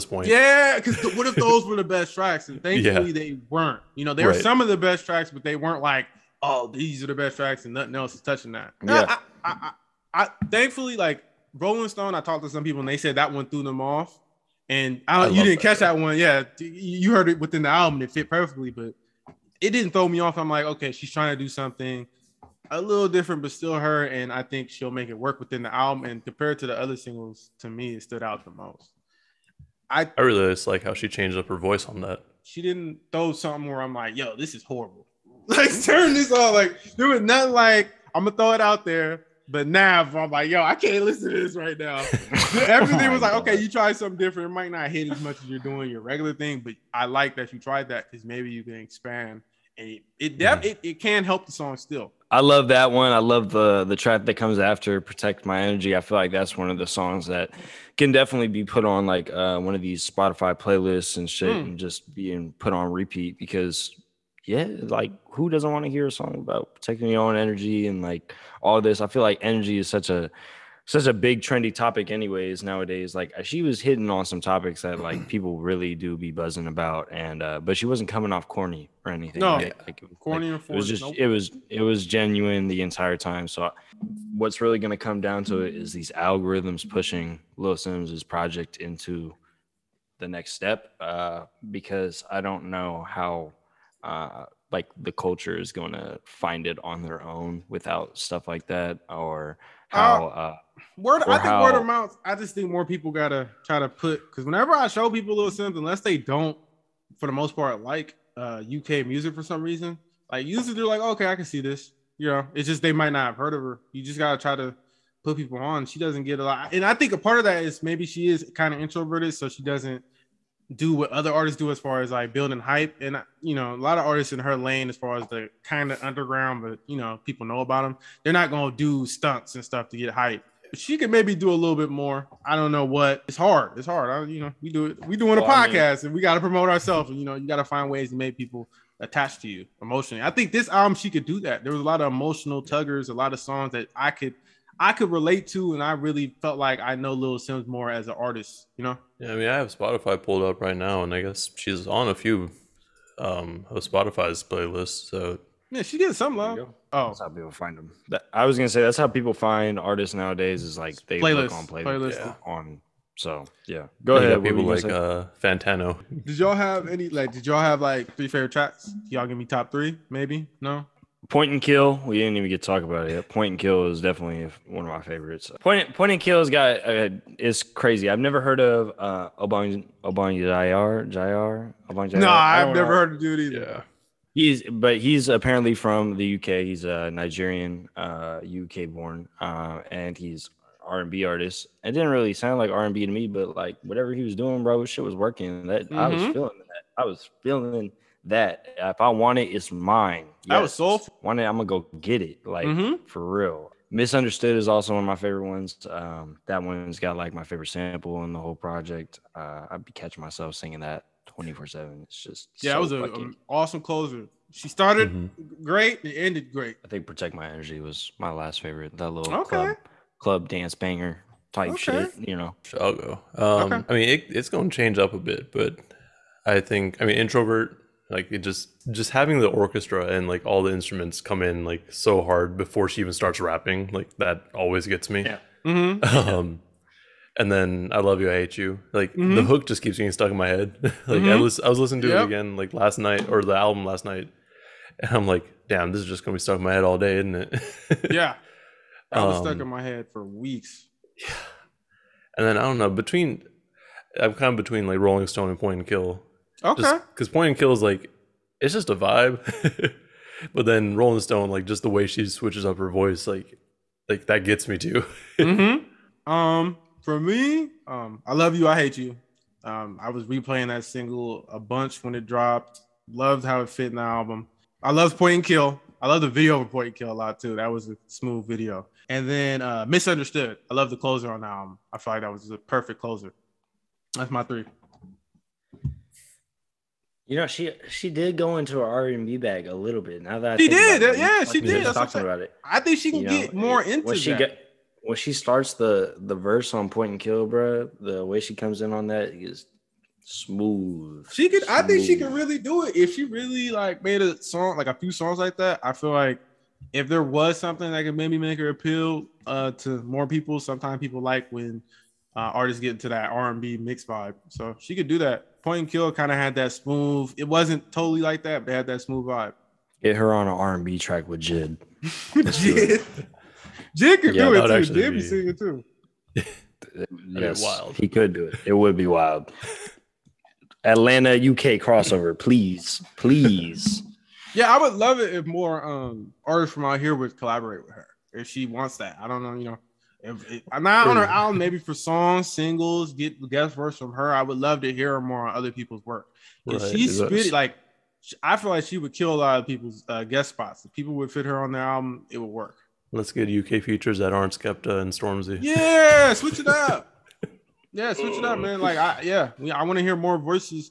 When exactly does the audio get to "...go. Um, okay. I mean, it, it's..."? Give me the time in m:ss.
3:42.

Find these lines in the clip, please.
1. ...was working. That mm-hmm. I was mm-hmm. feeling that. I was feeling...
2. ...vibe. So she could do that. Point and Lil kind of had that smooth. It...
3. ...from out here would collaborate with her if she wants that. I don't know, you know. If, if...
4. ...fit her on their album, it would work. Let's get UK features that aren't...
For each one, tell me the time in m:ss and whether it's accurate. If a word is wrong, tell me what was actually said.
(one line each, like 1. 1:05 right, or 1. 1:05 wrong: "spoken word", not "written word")
1. 3:15 right
2. 5:14 wrong: "Kill", not "Lil"
3. 5:36 right
4. 5:51 right.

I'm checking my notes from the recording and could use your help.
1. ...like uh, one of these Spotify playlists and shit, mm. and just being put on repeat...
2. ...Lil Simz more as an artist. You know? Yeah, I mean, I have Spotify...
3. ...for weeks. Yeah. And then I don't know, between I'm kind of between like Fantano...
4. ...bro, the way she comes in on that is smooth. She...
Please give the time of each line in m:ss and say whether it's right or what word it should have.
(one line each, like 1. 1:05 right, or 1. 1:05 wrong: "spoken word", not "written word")
1. 0:59 right
2. 2:27 right
3. 4:10 wrong: "Rolling", not "Fantano"
4. 4:57 right.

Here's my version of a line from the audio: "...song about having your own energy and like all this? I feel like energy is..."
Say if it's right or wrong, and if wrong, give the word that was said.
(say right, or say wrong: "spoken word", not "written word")
wrong: "protecting", not "having".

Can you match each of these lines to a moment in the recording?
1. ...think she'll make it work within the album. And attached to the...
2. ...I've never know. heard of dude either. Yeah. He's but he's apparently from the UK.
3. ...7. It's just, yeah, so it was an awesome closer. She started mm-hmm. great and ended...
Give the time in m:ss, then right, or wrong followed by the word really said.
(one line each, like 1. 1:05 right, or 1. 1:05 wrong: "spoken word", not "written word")
1. 0:24 wrong: "compared", not "attached"
2. 3:02 right
3. 3:31 right.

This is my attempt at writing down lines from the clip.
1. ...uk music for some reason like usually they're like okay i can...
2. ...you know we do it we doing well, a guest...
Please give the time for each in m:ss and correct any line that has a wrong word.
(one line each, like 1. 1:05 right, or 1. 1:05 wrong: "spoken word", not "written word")
1. 1:48 right
2. 2:14 wrong: "podcast", not "guest".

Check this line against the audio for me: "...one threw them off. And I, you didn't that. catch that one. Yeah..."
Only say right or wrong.
right.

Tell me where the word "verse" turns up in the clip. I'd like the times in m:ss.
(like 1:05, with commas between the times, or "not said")
4:56, 5:43.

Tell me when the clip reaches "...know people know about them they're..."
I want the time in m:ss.
2:06.